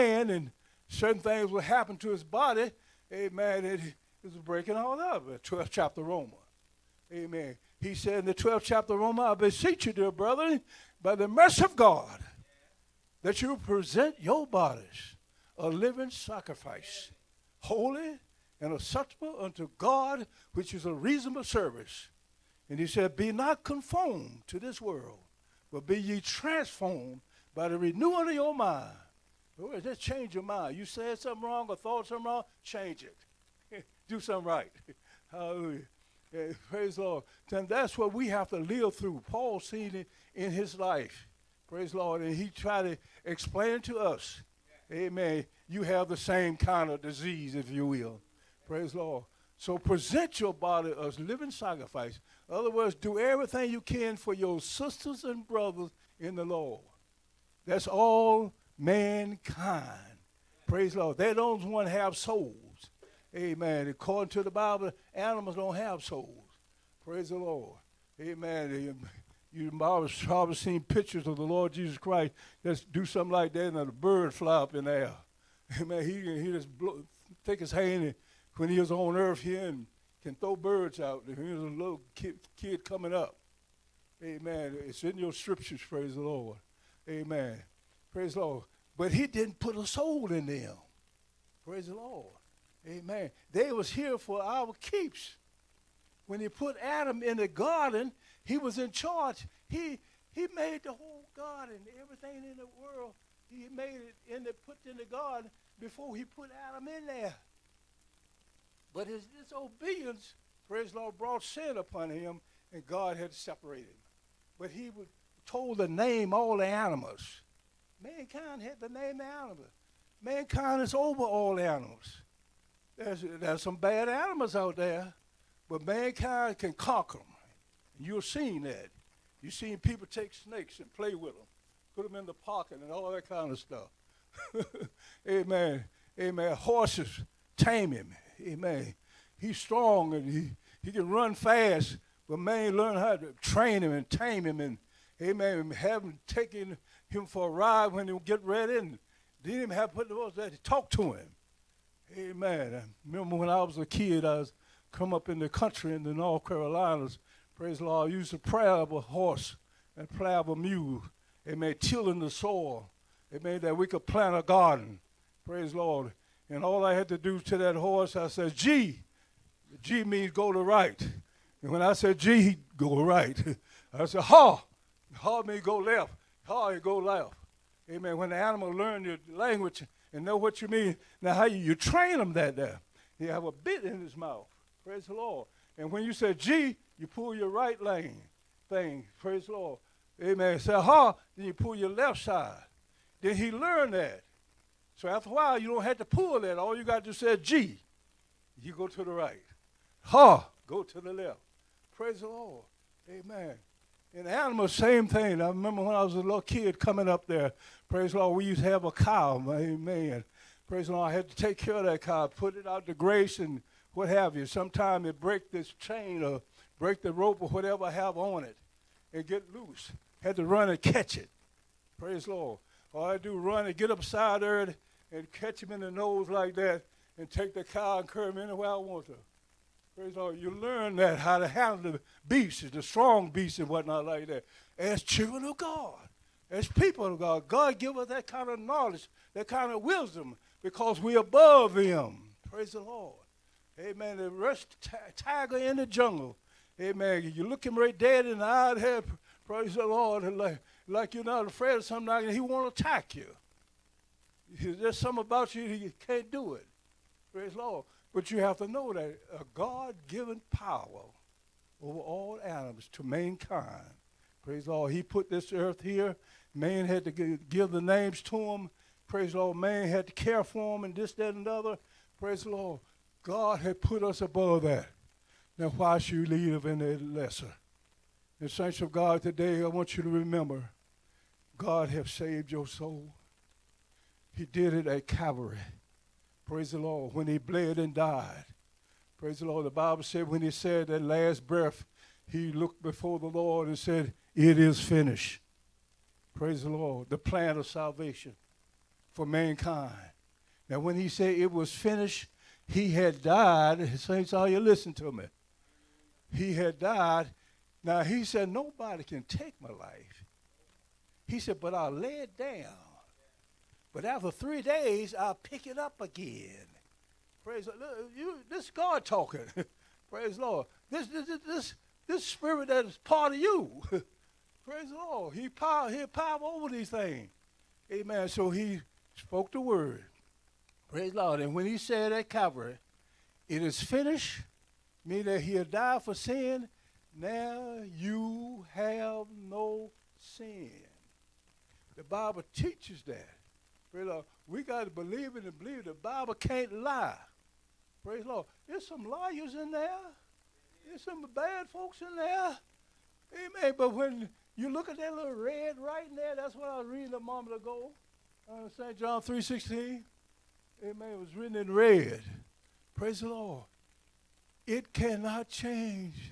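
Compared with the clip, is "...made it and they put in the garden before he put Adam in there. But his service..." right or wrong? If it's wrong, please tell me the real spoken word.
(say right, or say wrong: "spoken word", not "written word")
wrong: "disobedience", not "service".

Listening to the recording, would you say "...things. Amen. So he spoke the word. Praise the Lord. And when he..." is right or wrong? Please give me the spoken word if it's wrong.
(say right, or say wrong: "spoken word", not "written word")
right.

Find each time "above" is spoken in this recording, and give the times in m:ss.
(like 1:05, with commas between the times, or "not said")
4:01, 4:34.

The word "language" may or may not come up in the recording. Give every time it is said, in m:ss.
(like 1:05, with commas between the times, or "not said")
2:59.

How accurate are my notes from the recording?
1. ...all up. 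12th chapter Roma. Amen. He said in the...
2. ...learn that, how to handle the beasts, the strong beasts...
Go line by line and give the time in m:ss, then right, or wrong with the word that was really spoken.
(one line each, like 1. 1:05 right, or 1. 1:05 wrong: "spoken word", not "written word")
1. 0:04 right
2. 3:50 right.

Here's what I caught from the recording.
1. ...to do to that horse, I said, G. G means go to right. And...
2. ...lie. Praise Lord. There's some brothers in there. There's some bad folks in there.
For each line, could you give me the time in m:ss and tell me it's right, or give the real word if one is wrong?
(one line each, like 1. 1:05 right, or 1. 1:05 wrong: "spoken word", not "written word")
1. 2:47 right
2. 5:46 wrong: "liars", not "brothers".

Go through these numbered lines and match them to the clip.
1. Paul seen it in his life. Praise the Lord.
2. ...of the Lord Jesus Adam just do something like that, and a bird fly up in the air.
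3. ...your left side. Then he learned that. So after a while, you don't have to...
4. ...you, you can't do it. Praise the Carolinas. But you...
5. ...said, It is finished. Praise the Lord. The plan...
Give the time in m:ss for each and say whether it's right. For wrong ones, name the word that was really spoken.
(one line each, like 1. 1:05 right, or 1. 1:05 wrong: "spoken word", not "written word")
1. 0:39 right
2. 1:11 wrong: "Christ", not "Adam"
3. 3:11 right
4. 4:15 wrong: "Lord", not "Carolinas"
5. 4:53 right.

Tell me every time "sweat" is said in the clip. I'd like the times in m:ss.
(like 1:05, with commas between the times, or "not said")
not said.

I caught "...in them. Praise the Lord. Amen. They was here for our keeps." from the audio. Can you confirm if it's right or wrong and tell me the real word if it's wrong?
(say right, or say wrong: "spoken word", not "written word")
right.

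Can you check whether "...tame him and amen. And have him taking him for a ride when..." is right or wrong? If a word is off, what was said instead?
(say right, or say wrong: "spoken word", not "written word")
right.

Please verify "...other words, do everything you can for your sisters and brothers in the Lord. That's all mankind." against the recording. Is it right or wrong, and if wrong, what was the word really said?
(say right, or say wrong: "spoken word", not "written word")
right.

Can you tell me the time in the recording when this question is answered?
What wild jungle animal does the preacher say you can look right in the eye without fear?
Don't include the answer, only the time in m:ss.
4:05.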